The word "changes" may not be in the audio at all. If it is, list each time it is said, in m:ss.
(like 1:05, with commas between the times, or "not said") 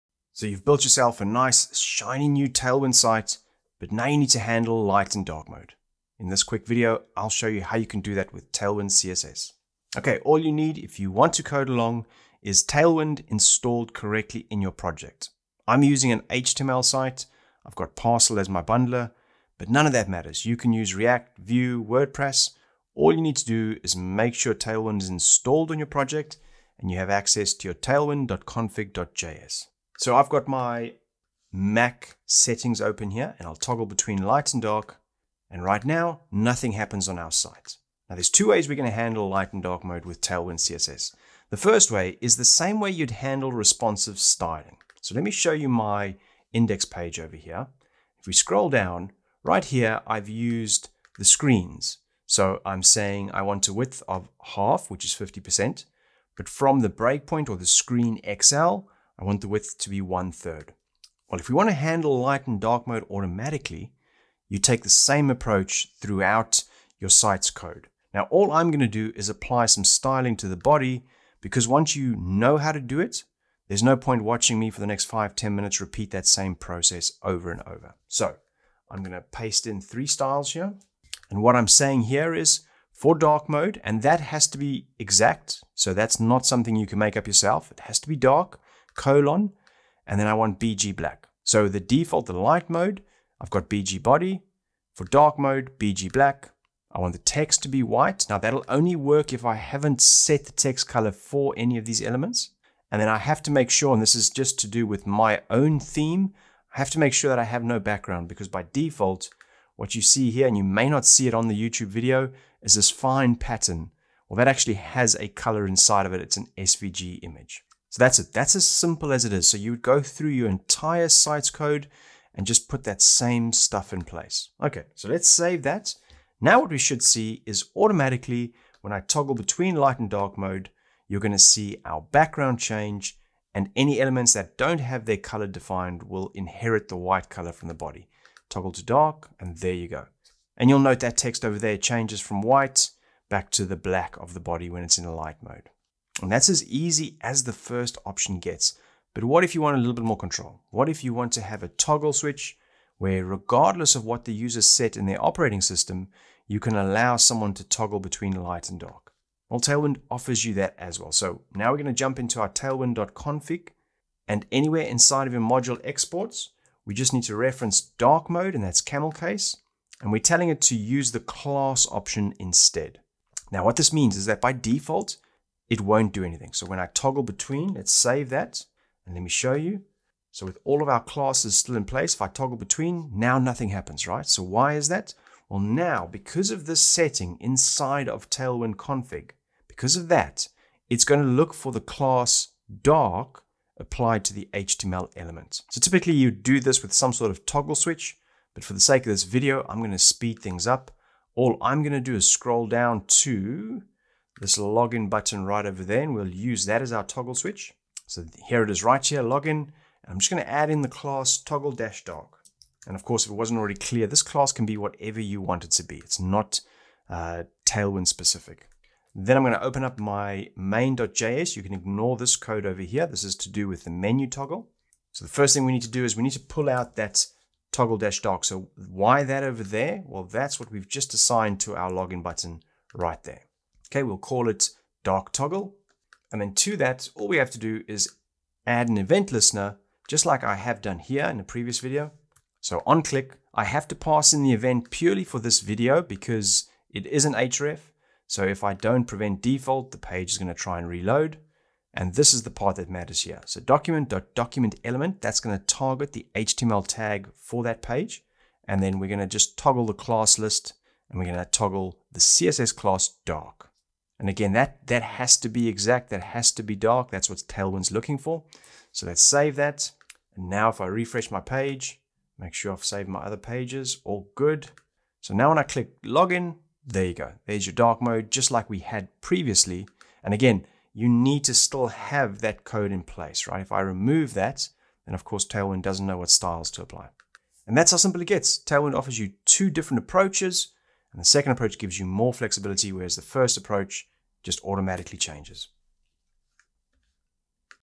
2:12, 2:21, 4:55.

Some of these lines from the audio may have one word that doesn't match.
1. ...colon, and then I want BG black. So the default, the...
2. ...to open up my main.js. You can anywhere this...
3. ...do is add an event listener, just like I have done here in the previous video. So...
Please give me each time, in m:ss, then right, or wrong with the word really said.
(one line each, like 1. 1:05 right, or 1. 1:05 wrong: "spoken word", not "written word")
1. 1:28 right
2. 3:39 wrong: "ignore", not "anywhere"
3. 3:57 right.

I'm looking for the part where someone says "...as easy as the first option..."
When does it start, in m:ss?
2:26.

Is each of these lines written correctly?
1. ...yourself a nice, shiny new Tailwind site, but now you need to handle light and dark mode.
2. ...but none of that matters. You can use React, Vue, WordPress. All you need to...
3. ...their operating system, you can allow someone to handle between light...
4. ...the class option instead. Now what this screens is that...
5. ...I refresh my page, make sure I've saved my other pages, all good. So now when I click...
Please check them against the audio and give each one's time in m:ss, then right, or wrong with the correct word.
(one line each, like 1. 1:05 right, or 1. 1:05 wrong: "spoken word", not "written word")
1. 0:00 right
2. 0:19 right
3. 2:35 wrong: "toggle", not "handle"
4. 2:51 wrong: "means", not "screens"
5. 4:30 right.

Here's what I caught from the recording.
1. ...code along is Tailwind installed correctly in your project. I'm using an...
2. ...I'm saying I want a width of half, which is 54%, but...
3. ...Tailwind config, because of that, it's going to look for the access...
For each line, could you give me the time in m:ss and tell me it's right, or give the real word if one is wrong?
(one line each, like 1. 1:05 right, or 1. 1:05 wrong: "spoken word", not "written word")
1. 0:11 right
2. 0:52 wrong: "50", not "54"
3. 3:08 wrong: "class", not "access".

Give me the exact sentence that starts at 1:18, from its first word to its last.
So I'm going to paste in three styles here.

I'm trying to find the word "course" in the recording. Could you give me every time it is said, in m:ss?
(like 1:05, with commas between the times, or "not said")
3:33, 4:45.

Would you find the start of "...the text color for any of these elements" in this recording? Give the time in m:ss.
1:40.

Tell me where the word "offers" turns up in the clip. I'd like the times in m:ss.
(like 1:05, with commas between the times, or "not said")
2:40, 4:48.